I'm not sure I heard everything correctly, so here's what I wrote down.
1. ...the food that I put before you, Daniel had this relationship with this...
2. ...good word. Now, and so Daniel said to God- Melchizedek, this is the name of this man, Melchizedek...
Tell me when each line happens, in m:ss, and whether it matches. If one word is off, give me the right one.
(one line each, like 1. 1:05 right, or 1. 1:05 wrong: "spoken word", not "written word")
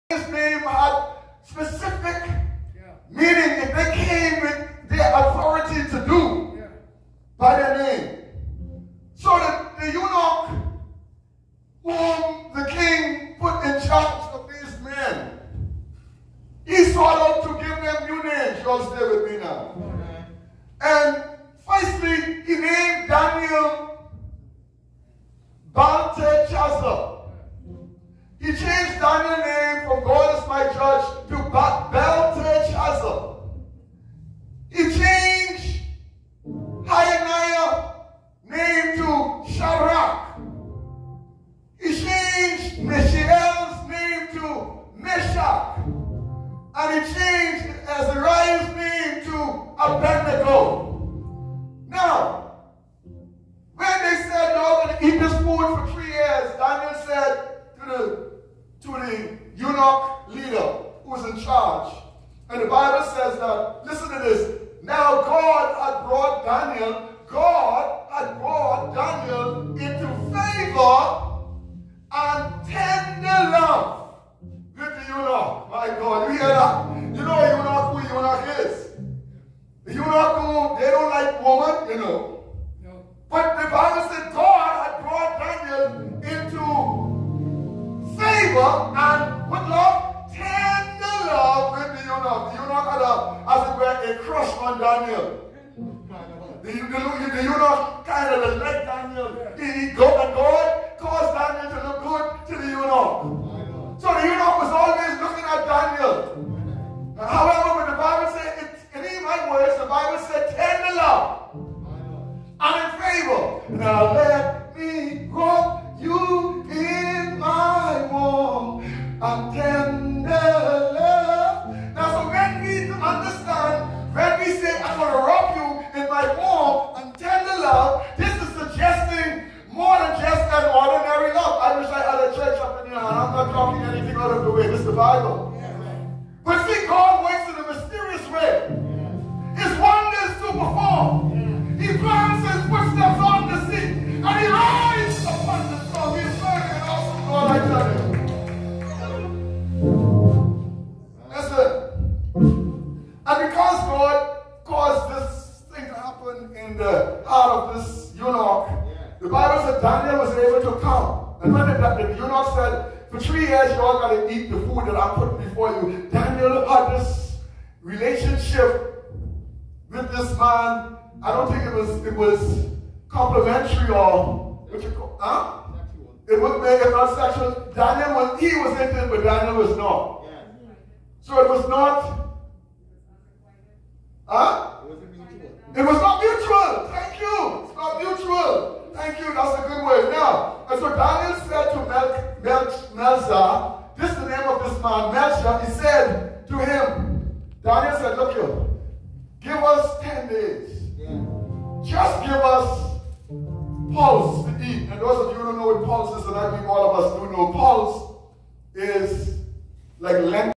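1. 2:44 right
2. 3:09 wrong: "Mel", not "God".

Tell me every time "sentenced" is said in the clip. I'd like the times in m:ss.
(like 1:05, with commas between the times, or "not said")
not said.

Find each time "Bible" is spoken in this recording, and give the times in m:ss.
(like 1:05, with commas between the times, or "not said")
1:02, 1:23, 2:14, 2:39.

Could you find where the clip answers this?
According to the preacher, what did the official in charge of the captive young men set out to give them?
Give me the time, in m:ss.
0:18.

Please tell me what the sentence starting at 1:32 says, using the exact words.
The Eunuch had, a, as it were, a crush on Daniel.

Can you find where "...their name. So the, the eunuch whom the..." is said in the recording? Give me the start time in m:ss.
0:07.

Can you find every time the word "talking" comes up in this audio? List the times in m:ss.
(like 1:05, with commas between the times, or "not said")
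2:13.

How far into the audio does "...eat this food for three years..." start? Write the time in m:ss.
0:55.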